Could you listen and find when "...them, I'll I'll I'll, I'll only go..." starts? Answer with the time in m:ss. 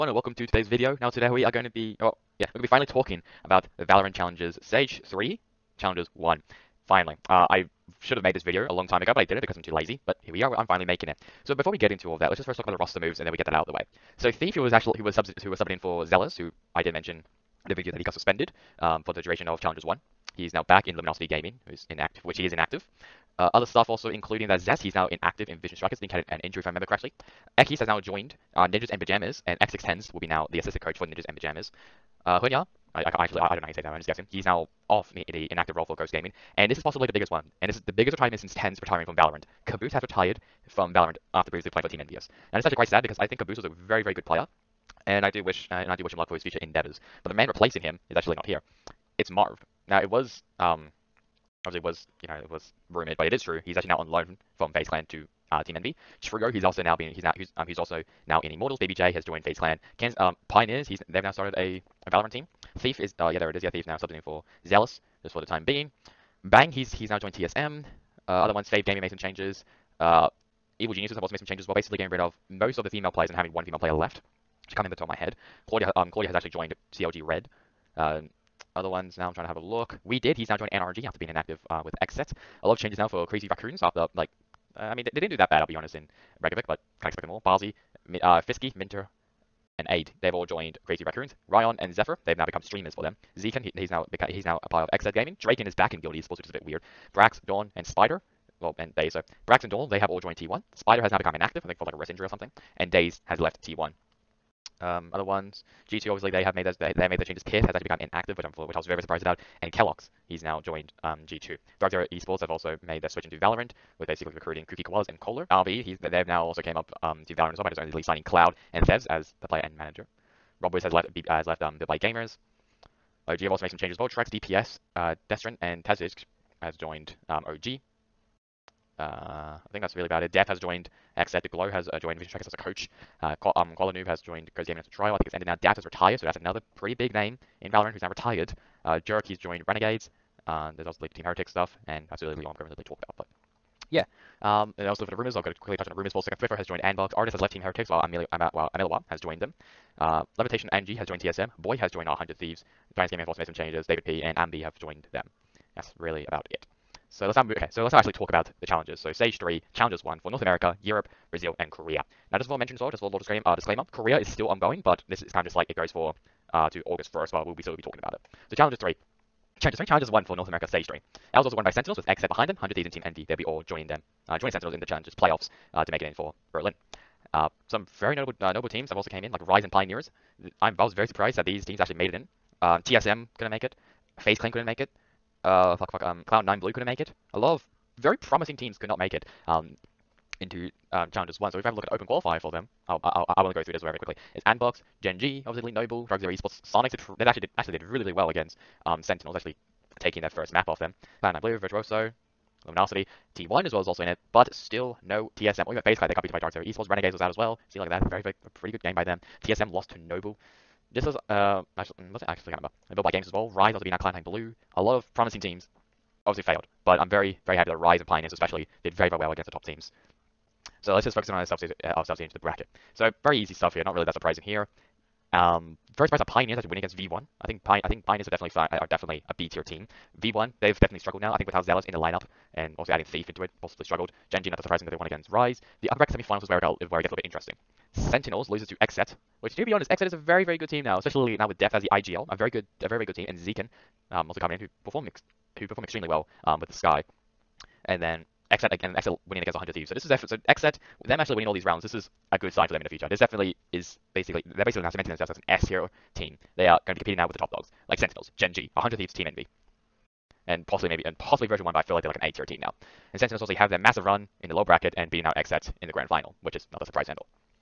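3:12.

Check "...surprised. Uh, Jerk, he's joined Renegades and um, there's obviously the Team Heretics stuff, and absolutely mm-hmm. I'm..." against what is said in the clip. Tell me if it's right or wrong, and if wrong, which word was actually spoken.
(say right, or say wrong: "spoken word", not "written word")
wrong: "retired", not "surprised".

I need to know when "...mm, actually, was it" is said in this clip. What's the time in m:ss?
3:31.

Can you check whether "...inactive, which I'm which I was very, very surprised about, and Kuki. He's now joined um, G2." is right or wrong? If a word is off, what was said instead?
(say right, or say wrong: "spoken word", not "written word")
wrong: "Keloqz", not "Kuki".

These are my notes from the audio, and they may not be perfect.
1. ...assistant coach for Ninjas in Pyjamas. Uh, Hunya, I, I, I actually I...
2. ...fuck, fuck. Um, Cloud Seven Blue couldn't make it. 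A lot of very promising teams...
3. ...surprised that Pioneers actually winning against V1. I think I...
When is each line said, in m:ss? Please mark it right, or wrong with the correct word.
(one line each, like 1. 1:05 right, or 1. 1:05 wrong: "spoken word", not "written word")
1. 0:30 right
2. 3:05 wrong: "Nine", not "Seven"
3. 3:46 right.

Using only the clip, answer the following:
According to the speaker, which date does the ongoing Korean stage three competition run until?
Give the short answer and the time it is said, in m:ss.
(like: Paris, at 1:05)
August 1st, at 2:46.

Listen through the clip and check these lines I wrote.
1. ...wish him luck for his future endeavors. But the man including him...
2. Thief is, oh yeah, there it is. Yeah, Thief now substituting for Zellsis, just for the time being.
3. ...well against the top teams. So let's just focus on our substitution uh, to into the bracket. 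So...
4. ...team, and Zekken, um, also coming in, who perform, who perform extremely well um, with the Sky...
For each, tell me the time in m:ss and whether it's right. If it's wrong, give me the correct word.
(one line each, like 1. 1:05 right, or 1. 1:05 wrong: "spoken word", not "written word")
1. 0:46 wrong: "replacing", not "including"
2. 1:02 right
3. 3:39 right
4. 4:03 right.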